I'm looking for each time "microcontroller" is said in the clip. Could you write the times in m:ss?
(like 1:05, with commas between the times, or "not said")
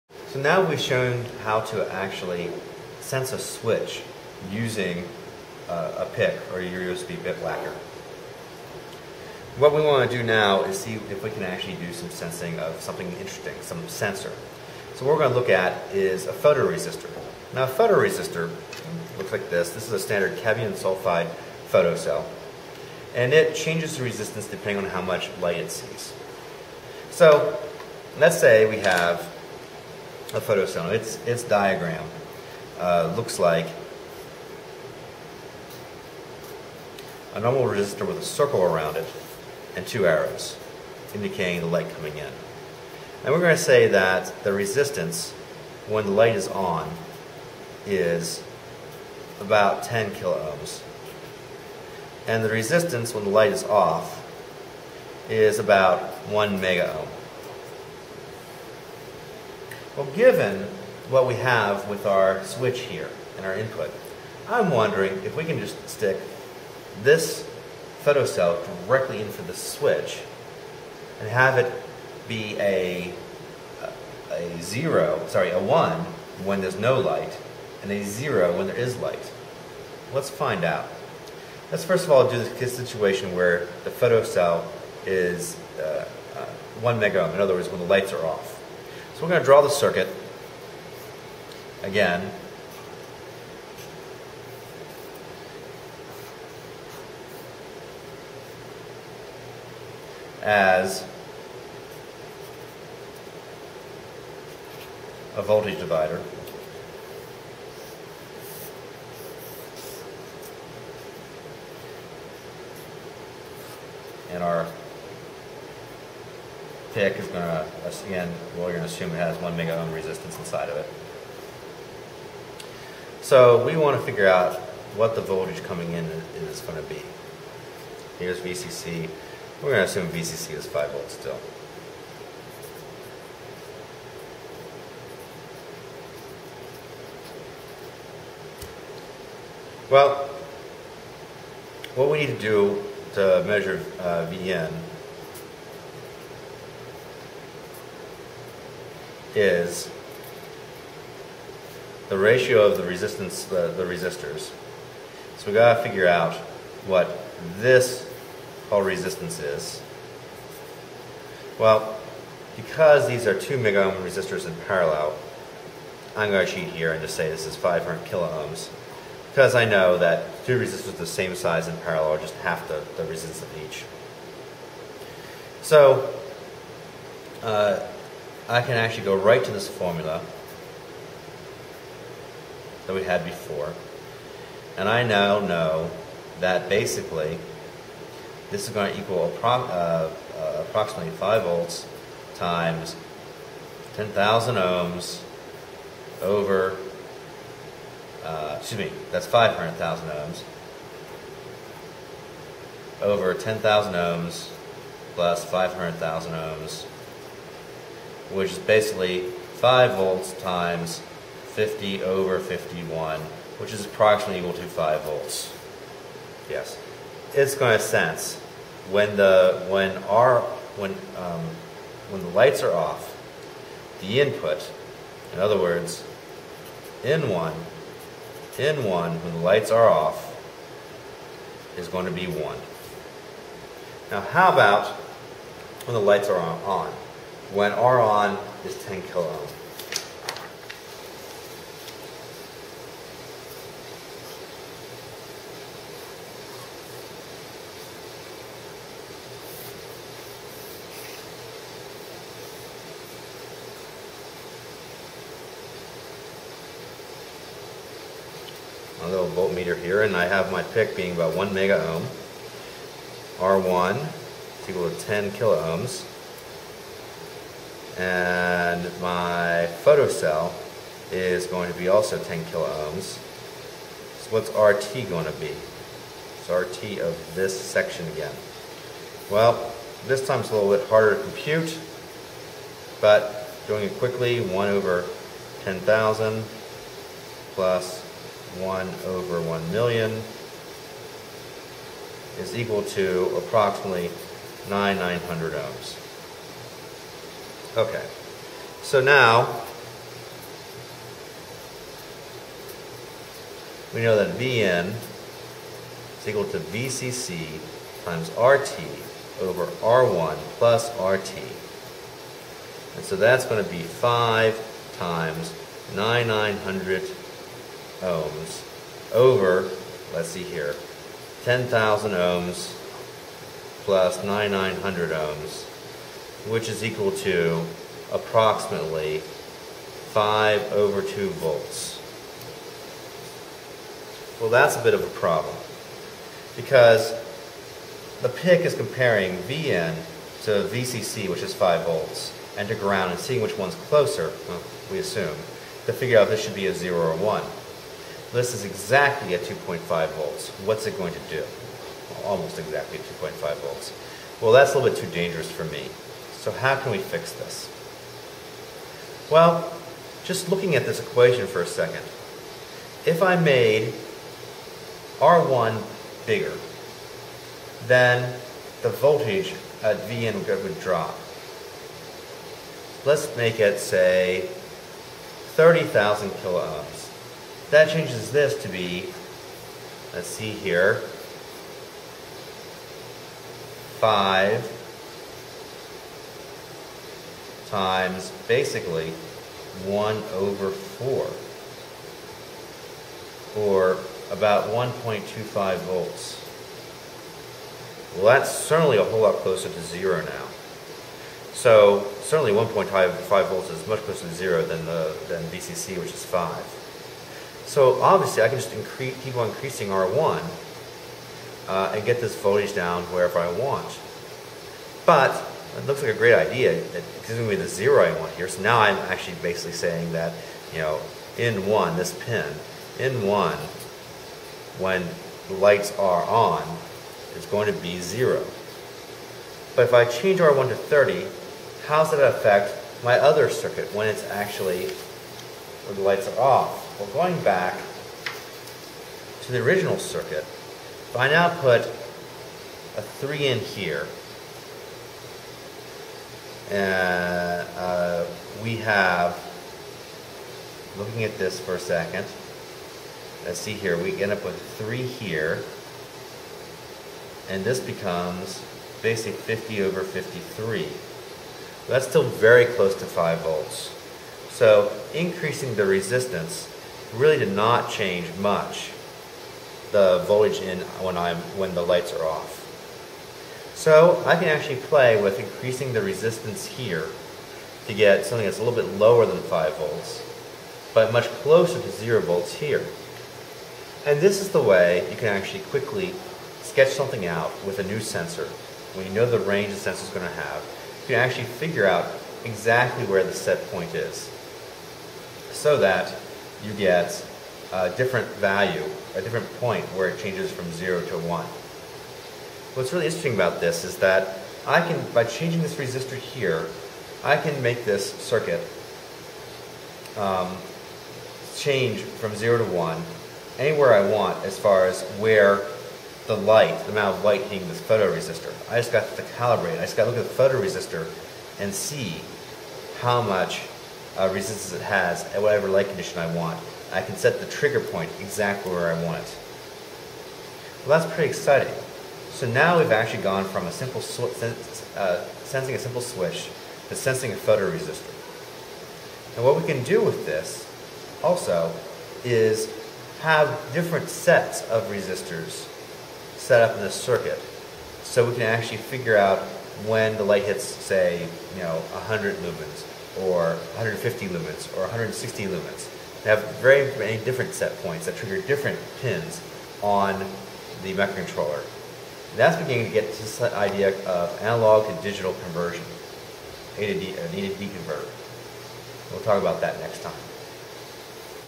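9:20.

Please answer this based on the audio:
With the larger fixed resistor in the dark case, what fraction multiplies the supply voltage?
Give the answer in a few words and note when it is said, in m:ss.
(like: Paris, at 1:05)
50 over 53, at 7:39.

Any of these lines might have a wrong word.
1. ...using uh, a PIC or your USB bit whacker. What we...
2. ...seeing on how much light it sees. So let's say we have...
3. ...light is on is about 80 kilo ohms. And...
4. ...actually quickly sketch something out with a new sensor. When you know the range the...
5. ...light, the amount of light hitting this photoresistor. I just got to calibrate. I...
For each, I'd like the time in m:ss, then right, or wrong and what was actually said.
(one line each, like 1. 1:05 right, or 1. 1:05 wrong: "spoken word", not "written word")
1. 0:04 right
2. 0:24 wrong: "depending", not "seeing"
3. 0:46 wrong: "10", not "80"
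4. 8:05 right
5. 8:36 right.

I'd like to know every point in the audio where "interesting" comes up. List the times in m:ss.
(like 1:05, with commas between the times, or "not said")
0:13, 8:23.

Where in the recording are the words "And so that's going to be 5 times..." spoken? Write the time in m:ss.
5:12.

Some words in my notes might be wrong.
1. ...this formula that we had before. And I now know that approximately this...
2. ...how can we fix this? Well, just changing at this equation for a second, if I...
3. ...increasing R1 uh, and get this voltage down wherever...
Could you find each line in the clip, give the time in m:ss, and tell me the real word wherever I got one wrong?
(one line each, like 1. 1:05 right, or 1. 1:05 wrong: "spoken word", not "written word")
1. 2:59 wrong: "basically", not "approximately"
2. 5:56 wrong: "looking", not "changing"
3. 6:49 right.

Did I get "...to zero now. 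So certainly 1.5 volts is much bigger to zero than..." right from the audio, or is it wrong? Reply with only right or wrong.
wrong.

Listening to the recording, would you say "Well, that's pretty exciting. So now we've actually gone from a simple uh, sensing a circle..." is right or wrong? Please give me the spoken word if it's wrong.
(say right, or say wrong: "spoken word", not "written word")
wrong: "simple", not "circle".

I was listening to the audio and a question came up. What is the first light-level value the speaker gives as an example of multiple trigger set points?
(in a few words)
100 lumens.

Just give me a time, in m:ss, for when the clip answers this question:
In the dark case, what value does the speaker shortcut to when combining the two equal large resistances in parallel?
2:47.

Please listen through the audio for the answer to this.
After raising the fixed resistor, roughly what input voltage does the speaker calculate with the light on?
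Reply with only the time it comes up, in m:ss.
6:34.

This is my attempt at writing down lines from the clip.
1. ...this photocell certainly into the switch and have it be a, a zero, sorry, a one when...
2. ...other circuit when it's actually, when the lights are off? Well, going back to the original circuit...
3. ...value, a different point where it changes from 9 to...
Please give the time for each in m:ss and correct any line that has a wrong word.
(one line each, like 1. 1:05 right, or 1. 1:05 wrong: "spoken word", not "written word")
1. 1:07 wrong: "directly", not "certainly"
2. 7:13 right
3. 8:18 wrong: "0", not "9".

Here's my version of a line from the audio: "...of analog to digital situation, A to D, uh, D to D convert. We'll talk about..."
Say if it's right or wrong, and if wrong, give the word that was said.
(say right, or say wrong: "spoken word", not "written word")
wrong: "conversion", not "situation".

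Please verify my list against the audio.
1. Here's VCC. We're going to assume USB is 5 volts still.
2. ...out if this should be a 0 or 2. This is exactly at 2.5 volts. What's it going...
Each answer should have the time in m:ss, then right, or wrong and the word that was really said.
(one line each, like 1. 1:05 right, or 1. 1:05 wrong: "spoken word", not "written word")
1. 2:08 wrong: "VCC", not "USB"
2. 5:46 wrong: "1", not "2".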